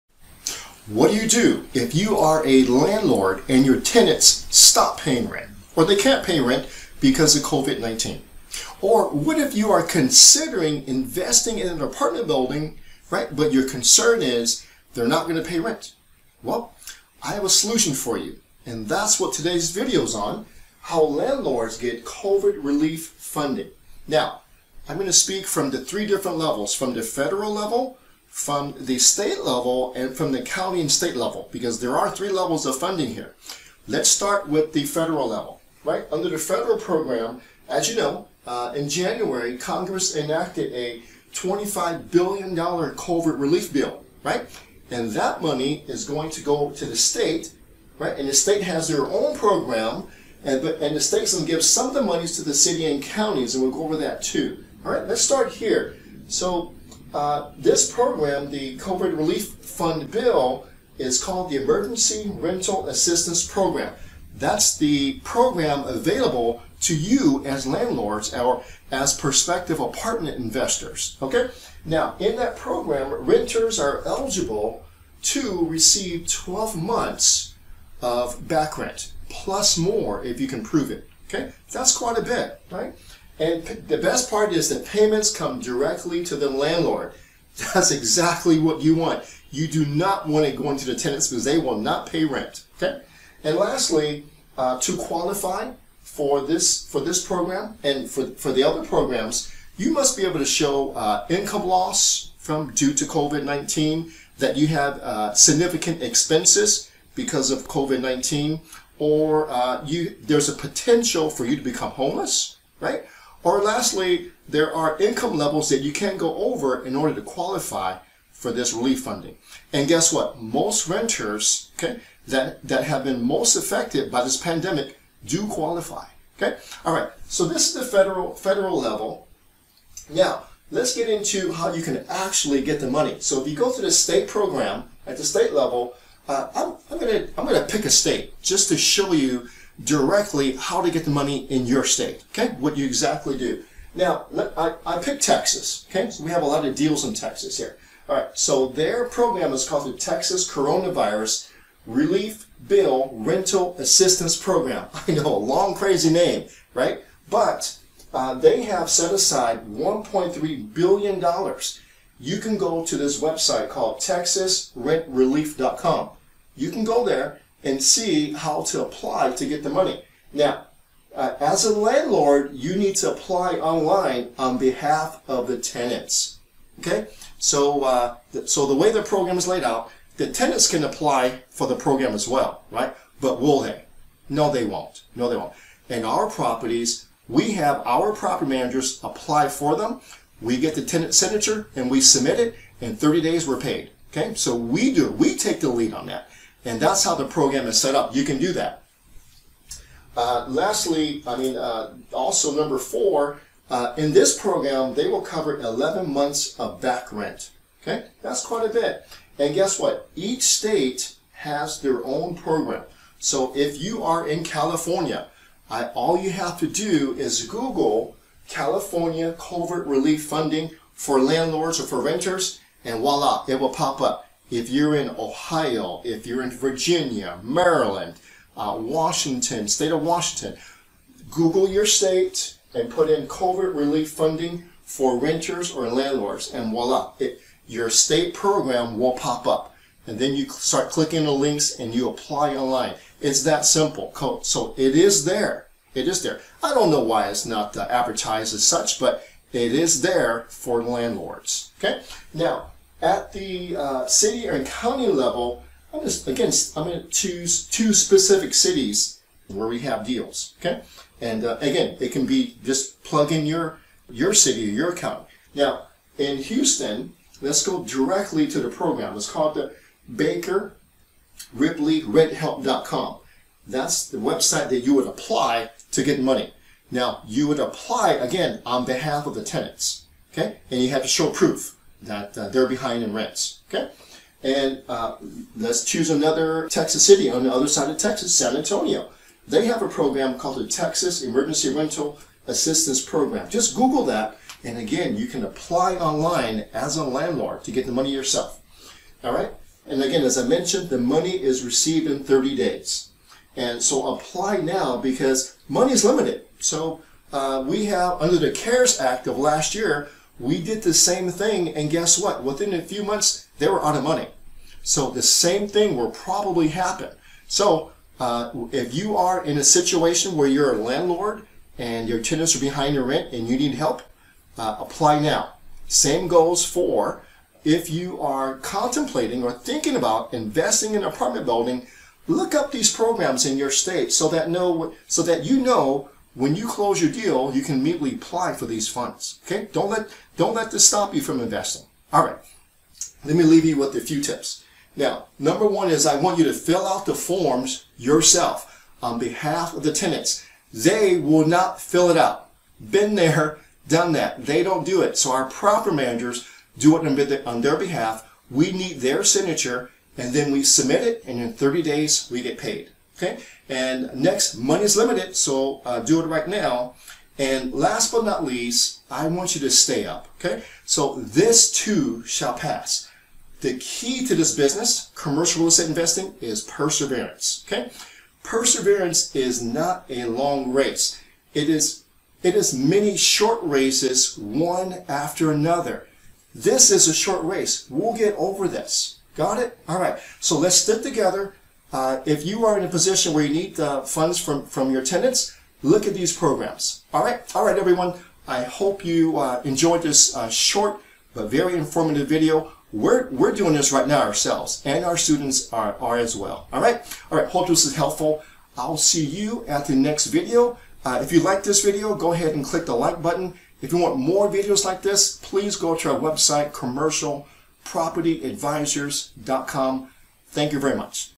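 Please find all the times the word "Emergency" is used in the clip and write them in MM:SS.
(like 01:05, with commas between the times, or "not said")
01:01, 04:51.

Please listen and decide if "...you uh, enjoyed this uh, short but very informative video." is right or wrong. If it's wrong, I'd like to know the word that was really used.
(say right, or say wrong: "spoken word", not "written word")
right.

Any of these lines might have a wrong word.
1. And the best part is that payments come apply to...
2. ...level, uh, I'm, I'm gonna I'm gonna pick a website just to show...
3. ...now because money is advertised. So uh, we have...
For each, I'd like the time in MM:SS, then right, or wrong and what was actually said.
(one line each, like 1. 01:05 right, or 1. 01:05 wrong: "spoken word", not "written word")
1. 01:23 wrong: "directly", not "apply"
2. 02:15 wrong: "state", not "website"
3. 05:04 wrong: "limited", not "advertised".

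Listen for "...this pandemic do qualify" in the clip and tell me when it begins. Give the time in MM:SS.
02:04.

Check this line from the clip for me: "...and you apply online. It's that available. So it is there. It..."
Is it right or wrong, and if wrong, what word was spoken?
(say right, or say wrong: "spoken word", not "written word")
wrong: "simple", not "available".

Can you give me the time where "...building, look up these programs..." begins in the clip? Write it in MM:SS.
05:31.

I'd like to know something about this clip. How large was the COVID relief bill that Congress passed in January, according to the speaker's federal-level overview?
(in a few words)
$25 billion.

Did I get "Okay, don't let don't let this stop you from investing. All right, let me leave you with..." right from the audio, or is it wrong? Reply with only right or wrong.
right.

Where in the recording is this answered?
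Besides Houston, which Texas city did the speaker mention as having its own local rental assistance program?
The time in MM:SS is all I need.
04:48.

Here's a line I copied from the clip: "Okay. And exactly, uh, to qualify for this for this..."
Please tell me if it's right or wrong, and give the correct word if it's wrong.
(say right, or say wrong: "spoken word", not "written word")
wrong: "lastly", not "exactly".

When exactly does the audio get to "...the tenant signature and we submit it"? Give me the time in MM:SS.
03:10.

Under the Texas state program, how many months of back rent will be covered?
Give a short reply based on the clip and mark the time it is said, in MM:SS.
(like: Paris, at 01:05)
11 months, at 03:25.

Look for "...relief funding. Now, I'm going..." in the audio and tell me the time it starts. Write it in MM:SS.
00:22.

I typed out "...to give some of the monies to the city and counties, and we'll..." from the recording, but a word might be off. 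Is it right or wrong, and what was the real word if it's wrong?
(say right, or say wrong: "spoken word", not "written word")
right.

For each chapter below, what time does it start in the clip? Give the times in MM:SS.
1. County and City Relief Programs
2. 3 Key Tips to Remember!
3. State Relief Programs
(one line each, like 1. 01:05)
1. 04:13
2. 05:43
3. 02:09.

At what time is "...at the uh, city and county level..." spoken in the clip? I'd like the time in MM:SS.
04:13.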